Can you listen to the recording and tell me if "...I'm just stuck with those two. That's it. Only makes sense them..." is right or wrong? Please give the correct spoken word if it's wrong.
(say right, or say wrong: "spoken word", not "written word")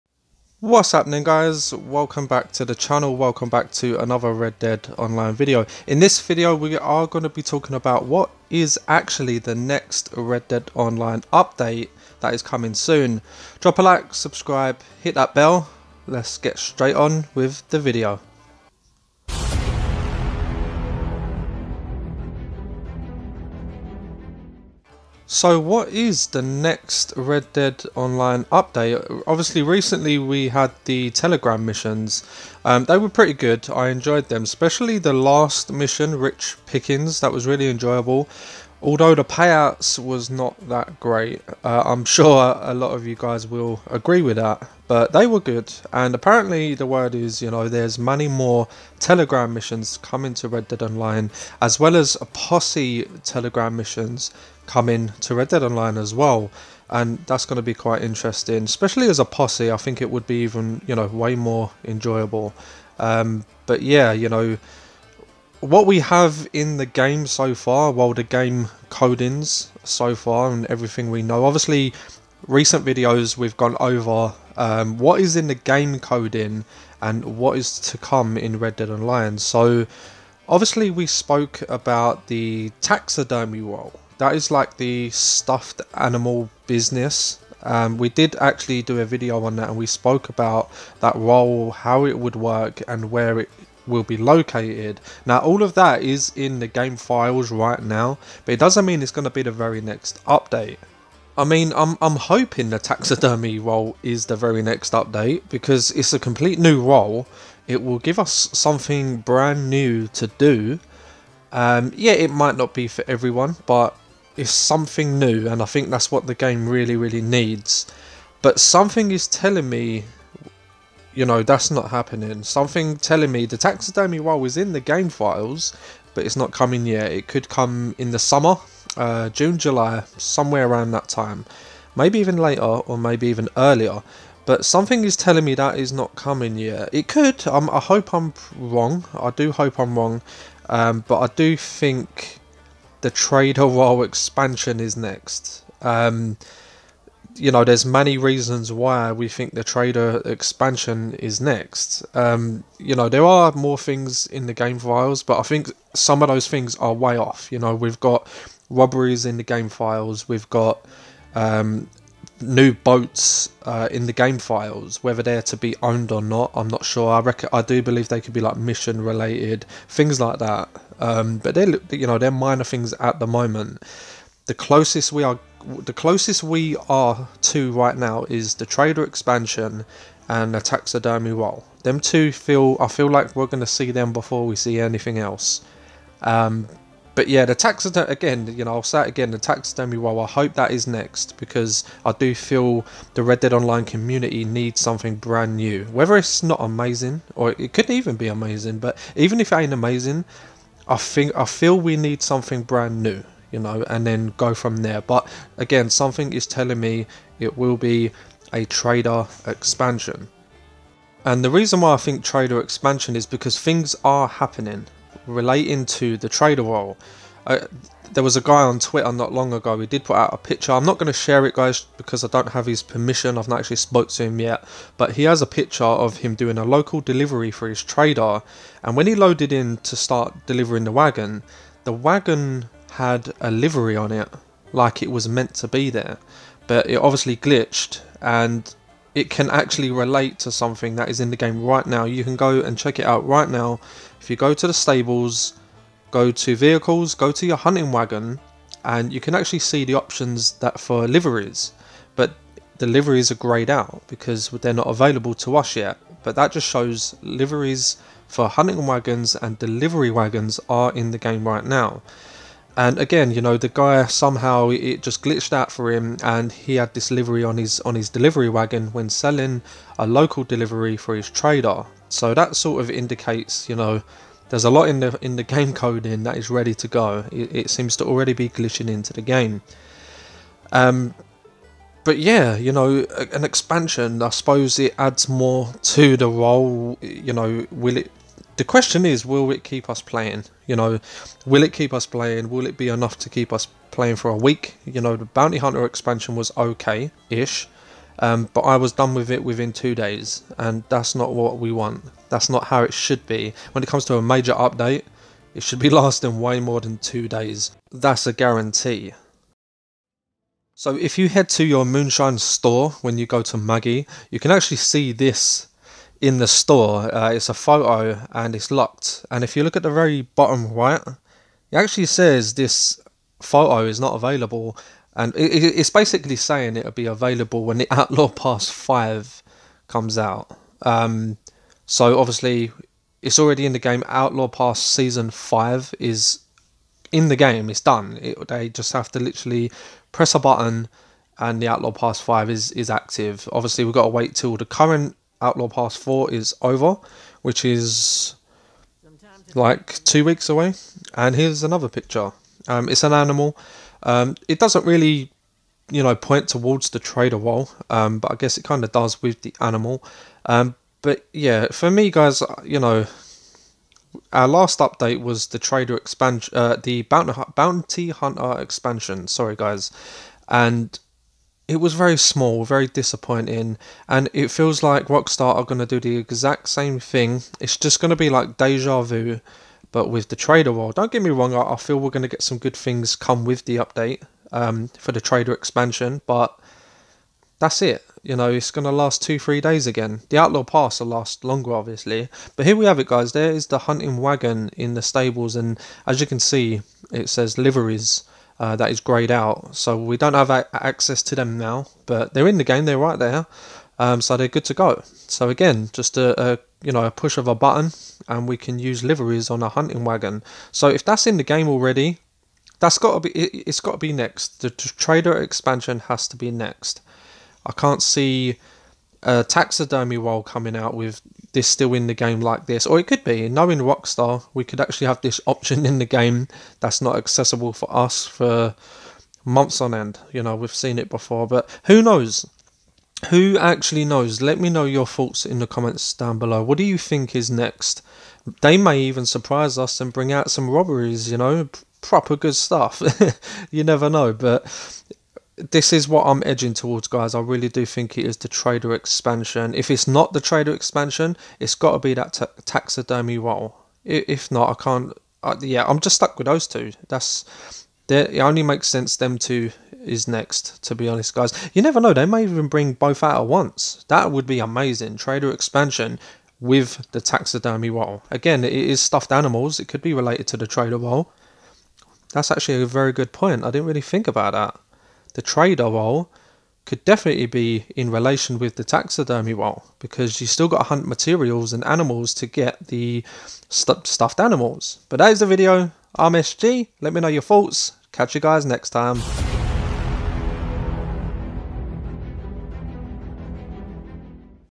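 right.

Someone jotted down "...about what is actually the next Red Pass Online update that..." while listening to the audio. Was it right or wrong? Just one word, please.
wrong.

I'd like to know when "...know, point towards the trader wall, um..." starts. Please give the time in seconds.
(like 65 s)
356 s.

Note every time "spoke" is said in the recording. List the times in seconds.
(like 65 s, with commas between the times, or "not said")
81 s, 89 s, 223 s.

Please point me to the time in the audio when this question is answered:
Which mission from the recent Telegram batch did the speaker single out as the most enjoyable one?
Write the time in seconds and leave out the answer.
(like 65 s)
36 s.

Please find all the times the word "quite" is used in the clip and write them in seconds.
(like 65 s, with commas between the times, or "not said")
57 s.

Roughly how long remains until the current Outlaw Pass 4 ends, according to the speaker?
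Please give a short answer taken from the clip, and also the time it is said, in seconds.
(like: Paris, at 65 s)
2 weeks, at 350 s.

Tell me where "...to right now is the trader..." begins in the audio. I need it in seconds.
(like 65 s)
177 s.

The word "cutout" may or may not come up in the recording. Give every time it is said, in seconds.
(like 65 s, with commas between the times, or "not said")
not said.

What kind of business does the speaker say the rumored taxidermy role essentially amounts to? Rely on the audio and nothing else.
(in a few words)
stuffed animal business.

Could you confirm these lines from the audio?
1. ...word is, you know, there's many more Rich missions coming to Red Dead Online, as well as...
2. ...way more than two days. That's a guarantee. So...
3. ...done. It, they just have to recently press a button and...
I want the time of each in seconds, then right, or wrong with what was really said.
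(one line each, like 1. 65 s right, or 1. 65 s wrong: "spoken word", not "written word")
1. 46 s wrong: "Telegram", not "Rich"
2. 306 s right
3. 337 s wrong: "literally", not "recently".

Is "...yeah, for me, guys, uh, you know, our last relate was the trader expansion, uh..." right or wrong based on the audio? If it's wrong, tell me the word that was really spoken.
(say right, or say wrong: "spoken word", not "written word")
wrong: "update", not "relate".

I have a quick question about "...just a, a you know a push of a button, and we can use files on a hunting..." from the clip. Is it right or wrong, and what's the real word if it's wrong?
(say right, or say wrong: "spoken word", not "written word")
wrong: "liveries", not "files".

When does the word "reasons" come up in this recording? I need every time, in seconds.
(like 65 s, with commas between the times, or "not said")
148 s, 211 s.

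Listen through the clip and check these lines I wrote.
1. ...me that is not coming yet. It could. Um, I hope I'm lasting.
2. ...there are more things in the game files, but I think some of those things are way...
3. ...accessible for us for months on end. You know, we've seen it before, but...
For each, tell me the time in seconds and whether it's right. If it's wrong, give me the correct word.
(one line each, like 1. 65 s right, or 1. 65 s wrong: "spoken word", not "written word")
1. 135 s wrong: "wrong", not "lasting"
2. 153 s right
3. 427 s right.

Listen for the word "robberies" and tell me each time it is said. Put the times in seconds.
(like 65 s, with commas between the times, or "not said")
158 s, 440 s.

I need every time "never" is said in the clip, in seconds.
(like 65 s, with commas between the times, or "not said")
443 s, 461 s.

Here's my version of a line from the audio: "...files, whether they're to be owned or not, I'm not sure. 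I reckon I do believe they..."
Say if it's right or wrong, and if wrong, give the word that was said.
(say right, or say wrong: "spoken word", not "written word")
right.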